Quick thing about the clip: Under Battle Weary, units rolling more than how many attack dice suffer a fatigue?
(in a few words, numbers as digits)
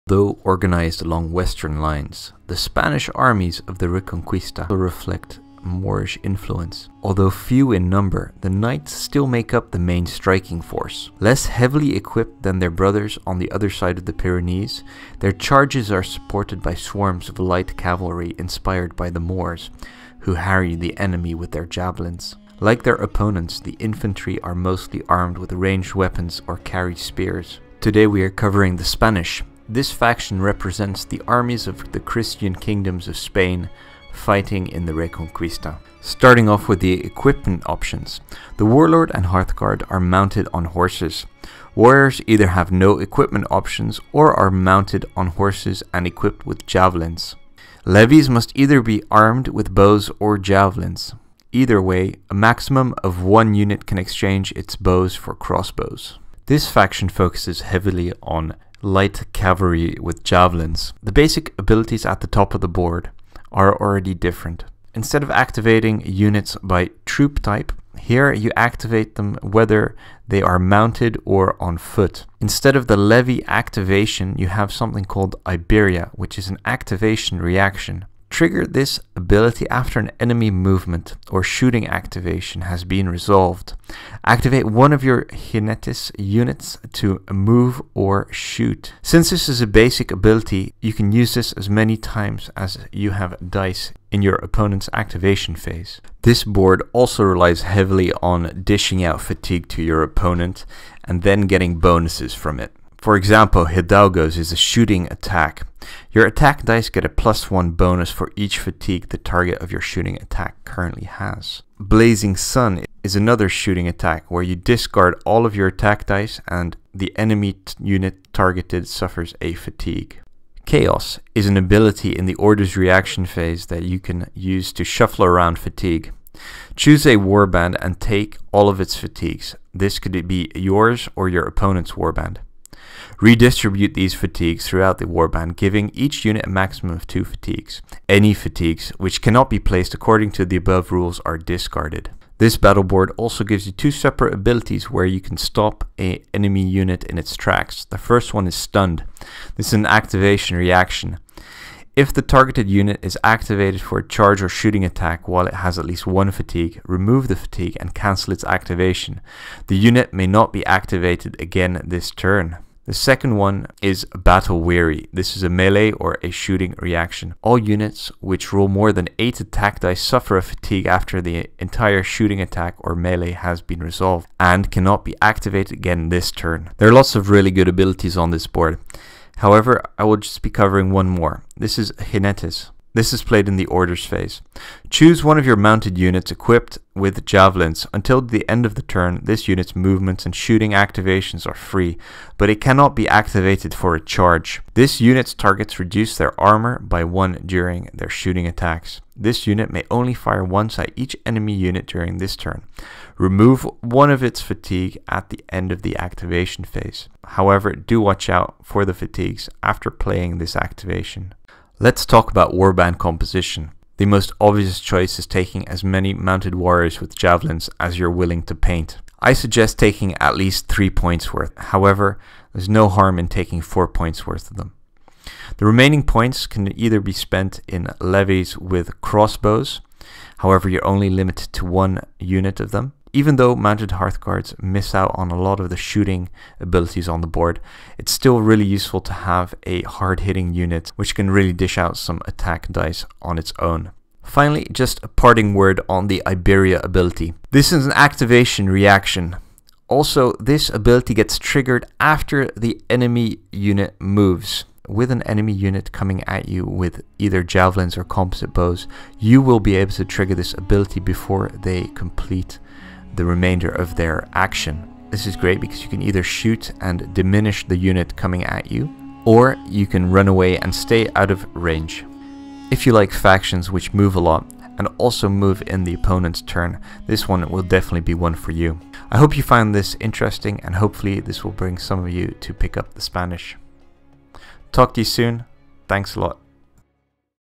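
8.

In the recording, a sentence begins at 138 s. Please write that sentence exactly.
Any fatigues which cannot be placed according to the above rules are discarded.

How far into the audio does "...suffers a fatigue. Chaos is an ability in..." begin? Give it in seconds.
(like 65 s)
118 s.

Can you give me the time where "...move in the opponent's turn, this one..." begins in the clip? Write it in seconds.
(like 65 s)
275 s.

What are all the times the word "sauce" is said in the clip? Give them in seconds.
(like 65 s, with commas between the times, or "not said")
not said.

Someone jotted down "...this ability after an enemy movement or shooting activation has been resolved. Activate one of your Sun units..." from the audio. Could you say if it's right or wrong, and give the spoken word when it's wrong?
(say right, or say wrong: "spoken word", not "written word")
wrong: "Jinetes", not "Sun".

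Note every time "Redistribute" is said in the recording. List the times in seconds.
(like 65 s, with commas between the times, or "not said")
133 s.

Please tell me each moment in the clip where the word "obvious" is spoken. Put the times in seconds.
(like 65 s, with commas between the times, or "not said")
214 s.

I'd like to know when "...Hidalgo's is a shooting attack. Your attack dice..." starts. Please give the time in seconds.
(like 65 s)
103 s.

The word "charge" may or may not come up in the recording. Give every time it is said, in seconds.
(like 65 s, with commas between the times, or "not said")
15 s, 154 s, 194 s.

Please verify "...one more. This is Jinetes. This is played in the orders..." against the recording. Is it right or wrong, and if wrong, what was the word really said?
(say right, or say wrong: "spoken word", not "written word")
right.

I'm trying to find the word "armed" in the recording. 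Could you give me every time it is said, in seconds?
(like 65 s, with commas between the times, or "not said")
25 s, 49 s.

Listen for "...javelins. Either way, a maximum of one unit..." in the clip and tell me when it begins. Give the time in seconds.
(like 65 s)
50 s.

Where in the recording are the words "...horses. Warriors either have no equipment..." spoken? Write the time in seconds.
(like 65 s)
40 s.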